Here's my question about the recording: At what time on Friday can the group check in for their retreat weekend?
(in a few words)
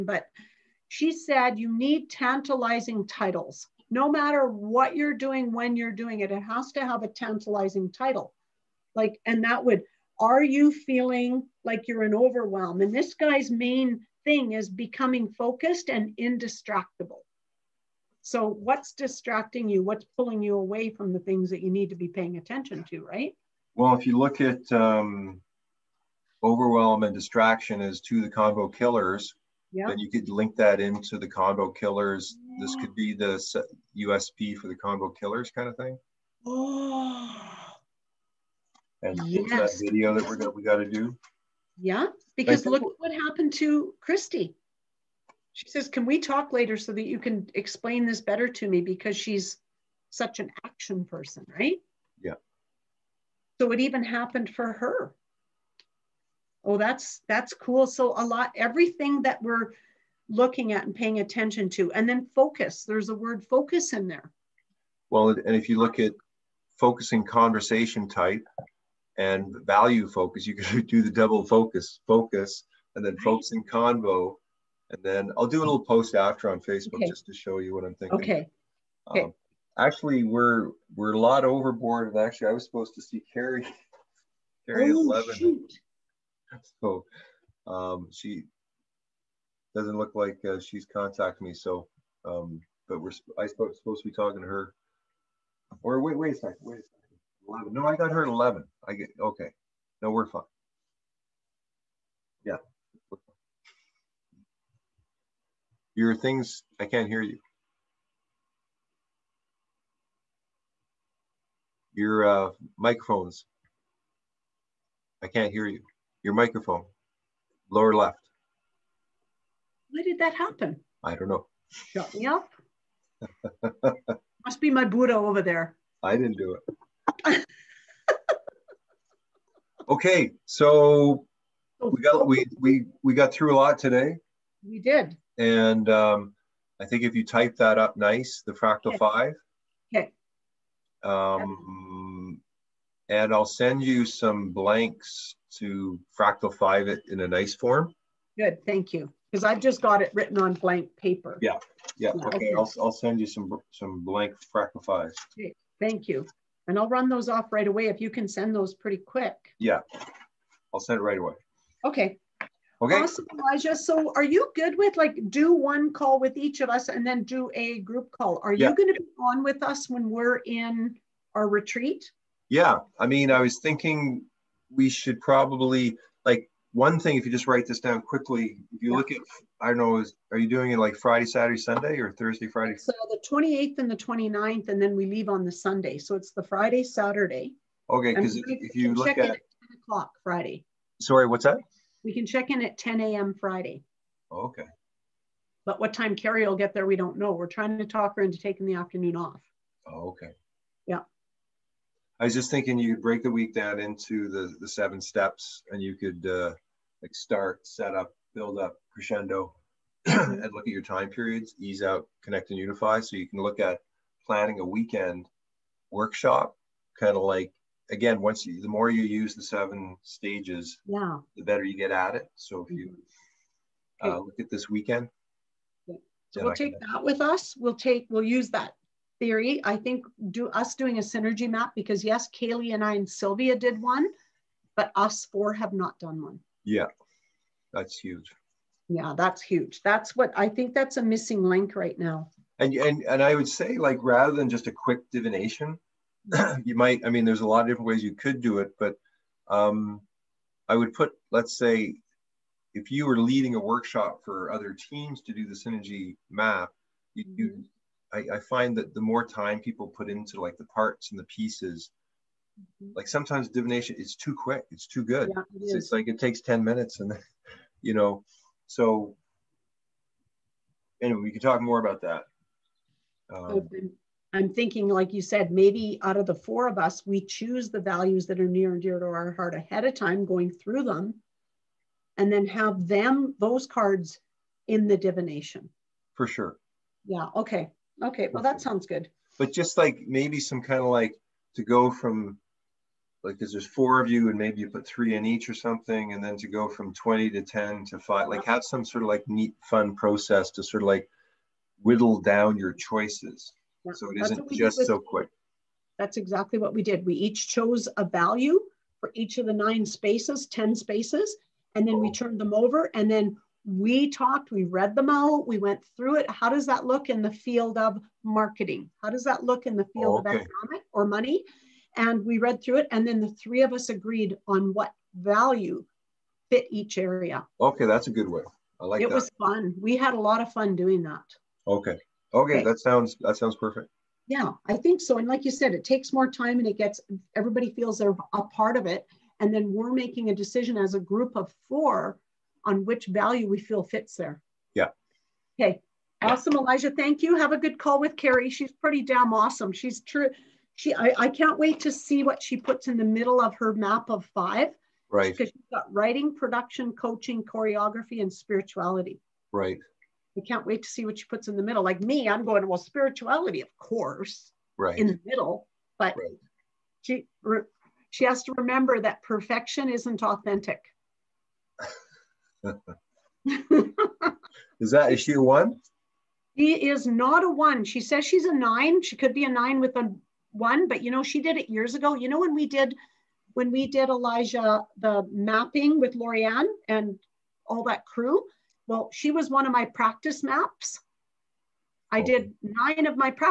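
10 a.m.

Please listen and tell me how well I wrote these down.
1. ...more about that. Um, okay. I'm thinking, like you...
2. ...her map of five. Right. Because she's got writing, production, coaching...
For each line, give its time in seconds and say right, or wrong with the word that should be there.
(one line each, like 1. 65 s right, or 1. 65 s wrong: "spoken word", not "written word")
1. 271 s right
2. 353 s right.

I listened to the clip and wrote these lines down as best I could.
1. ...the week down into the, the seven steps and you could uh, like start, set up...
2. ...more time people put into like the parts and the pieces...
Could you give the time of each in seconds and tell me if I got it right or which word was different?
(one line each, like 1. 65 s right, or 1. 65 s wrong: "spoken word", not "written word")
1. 203 s right
2. 259 s right.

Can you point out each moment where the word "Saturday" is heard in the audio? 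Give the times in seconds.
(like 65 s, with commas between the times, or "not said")
181 s, 186 s.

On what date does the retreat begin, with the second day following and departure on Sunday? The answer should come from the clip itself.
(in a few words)
28th.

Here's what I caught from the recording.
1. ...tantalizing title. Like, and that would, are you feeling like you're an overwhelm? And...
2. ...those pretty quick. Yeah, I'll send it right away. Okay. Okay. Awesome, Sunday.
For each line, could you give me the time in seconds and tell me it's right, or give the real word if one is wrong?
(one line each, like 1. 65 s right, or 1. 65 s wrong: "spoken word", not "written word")
1. 7 s right
2. 158 s wrong: "Elijah", not "Sunday".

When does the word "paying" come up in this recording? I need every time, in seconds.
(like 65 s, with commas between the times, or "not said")
22 s, 60 s.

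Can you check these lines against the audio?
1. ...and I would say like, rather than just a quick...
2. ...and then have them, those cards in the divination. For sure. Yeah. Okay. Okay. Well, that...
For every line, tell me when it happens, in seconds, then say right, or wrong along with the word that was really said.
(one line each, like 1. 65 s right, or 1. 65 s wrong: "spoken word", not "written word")
1. 243 s right
2. 282 s right.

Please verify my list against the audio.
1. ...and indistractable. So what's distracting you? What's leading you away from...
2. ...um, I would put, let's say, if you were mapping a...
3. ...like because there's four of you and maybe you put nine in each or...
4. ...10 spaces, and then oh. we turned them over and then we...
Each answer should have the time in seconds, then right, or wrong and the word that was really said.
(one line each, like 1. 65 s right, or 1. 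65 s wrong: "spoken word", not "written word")
1. 15 s wrong: "pulling", not "leading"
2. 249 s wrong: "leading", not "mapping"
3. 293 s wrong: "three", not "nine"
4. 310 s right.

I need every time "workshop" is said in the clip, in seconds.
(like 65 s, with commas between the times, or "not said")
215 s, 253 s.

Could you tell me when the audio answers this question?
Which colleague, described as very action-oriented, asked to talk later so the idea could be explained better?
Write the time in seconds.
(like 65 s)
43 s.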